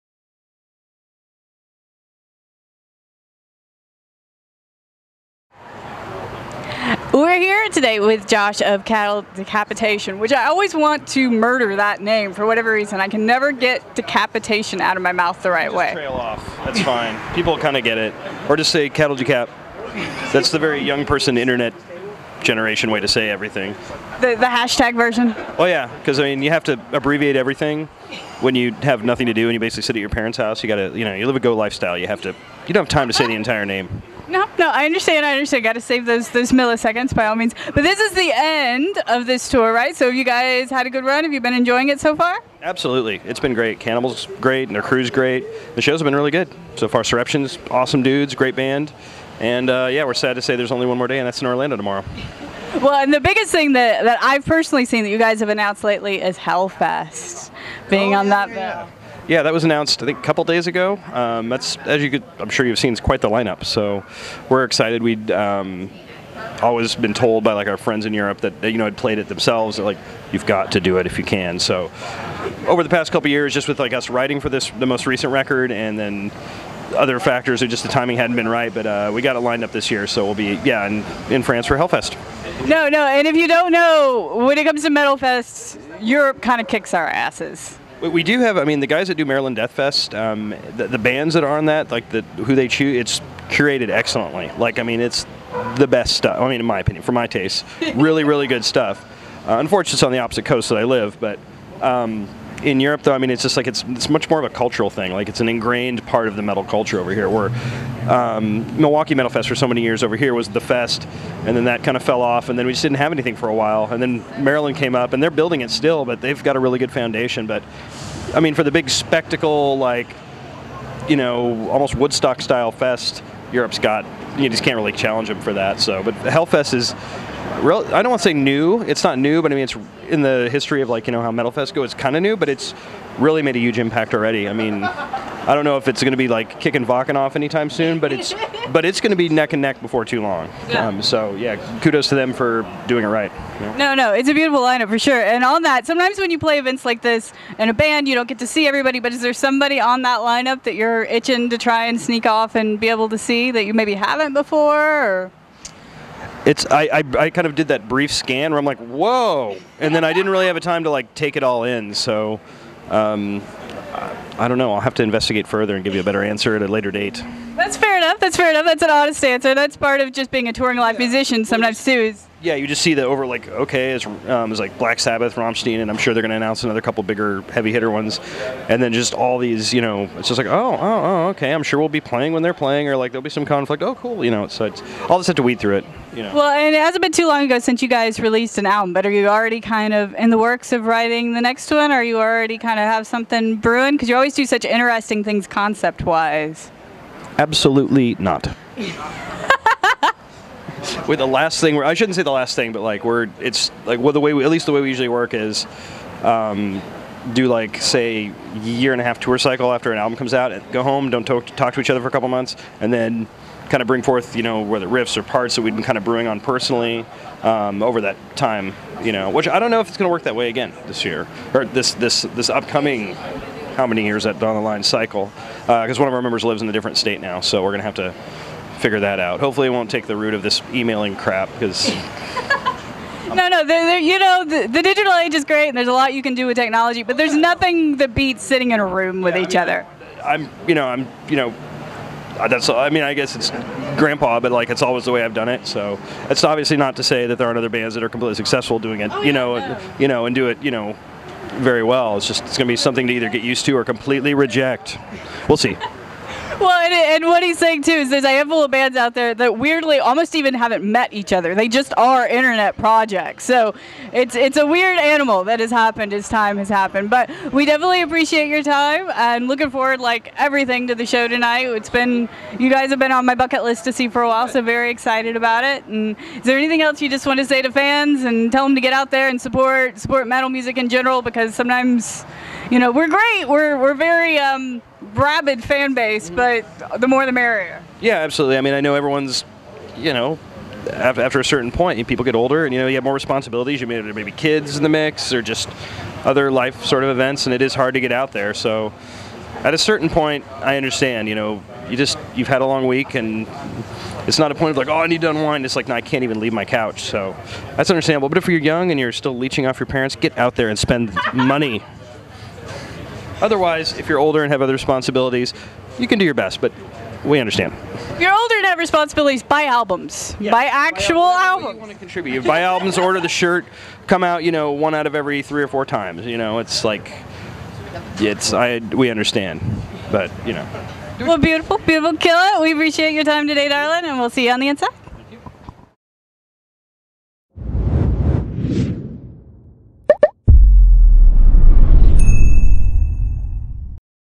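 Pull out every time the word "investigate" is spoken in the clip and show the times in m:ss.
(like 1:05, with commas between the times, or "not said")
2:45.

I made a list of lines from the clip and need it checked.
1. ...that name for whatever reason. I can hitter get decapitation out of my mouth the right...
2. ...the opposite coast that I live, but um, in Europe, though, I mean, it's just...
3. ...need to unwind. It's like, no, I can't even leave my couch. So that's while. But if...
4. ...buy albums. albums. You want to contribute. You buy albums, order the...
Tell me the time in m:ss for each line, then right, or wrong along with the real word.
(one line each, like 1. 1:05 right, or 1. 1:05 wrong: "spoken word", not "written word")
1. 0:11 wrong: "never", not "hitter"
2. 1:40 right
3. 5:05 wrong: "understandable", not "while"
4. 5:21 right.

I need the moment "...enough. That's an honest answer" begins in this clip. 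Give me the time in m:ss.
2:48.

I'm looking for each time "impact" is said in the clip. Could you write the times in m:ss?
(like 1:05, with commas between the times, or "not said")
2:13.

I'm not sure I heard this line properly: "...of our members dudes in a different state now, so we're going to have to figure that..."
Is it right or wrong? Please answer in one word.
wrong.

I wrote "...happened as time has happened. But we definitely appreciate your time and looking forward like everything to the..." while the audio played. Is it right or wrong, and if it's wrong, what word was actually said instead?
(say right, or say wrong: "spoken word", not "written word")
right.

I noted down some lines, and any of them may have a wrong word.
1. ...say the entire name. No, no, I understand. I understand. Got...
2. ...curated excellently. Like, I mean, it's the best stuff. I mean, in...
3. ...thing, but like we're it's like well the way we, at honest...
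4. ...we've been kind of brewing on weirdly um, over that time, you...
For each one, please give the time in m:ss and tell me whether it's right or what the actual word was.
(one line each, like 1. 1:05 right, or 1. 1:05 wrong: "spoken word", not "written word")
1. 0:33 right
2. 1:33 right
3. 3:22 wrong: "least", not "honest"
4. 3:35 wrong: "personally", not "weirdly".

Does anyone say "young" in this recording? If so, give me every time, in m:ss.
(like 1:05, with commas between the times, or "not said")
0:20, 5:08.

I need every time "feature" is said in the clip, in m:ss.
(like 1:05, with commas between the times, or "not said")
not said.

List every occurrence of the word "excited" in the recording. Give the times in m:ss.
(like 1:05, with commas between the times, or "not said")
1:04, 4:34.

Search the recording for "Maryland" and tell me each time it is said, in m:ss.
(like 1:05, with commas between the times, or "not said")
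1:29, 1:54.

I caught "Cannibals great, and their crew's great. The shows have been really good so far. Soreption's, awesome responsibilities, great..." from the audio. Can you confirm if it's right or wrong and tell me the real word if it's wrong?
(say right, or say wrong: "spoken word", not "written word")
wrong: "dudes", not "responsibilities".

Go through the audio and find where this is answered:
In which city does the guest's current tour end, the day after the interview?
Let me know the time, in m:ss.
0:51.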